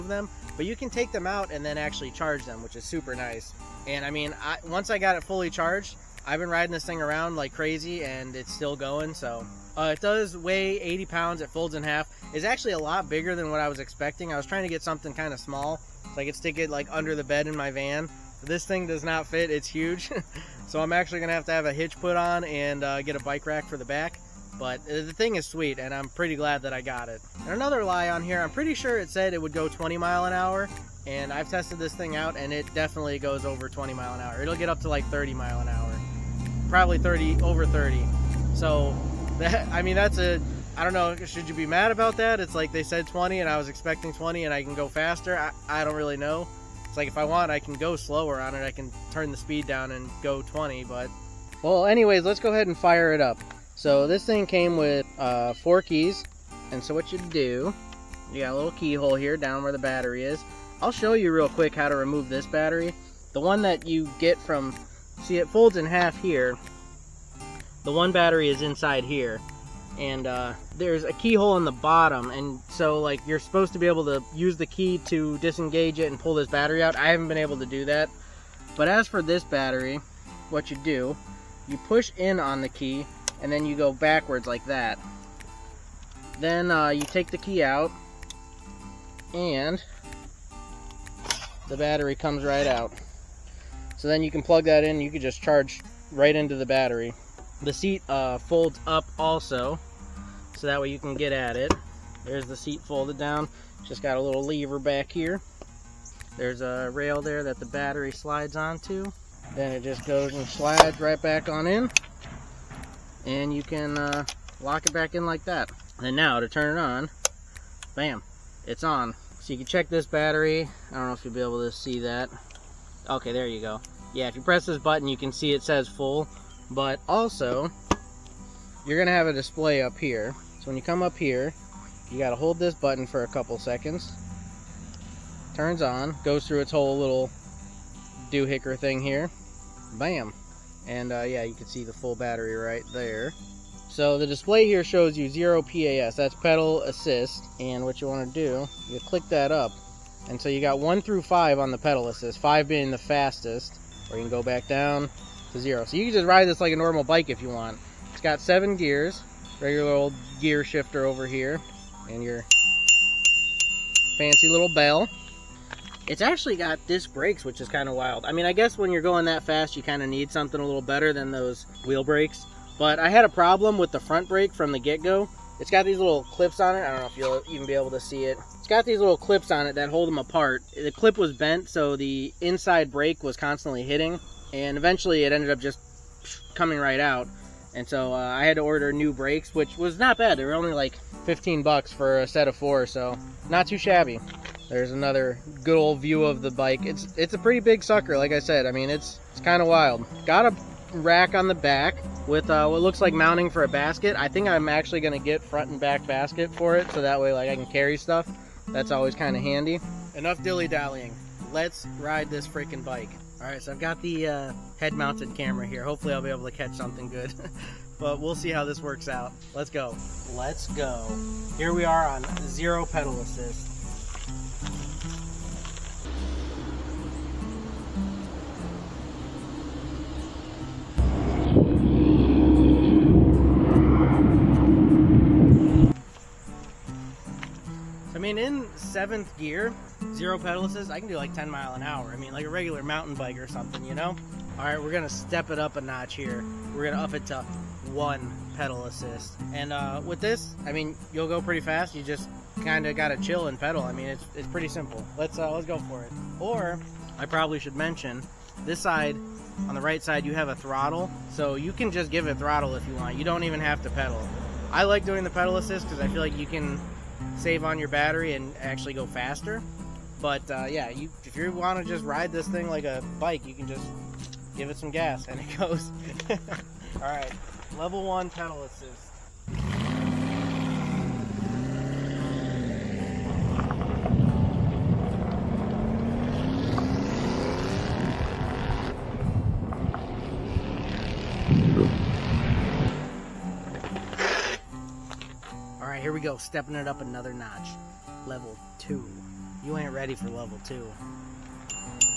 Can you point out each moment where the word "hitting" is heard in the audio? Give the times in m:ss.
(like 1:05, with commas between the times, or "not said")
3:03.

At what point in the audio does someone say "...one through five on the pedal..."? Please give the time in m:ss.
2:30.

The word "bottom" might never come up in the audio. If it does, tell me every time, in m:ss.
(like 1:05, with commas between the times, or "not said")
1:11.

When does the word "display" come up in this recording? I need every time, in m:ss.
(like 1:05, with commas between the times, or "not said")
2:09, 2:24.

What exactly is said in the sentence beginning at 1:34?
So then you can plug that in, you can just charge right into the battery.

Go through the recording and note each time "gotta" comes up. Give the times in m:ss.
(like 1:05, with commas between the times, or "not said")
2:12, 4:12.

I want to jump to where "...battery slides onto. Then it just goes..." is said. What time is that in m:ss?
1:47.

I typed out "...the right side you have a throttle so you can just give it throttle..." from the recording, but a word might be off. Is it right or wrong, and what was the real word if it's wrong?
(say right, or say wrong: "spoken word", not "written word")
right.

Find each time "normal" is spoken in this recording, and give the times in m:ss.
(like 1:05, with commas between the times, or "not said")
2:36.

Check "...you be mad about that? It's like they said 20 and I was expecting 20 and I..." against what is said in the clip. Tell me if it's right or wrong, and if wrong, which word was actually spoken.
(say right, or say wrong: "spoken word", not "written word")
right.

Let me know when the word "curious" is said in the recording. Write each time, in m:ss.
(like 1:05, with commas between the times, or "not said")
not said.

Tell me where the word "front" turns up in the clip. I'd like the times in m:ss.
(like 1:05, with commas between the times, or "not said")
2:54, 3:25.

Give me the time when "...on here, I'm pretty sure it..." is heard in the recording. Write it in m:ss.
0:28.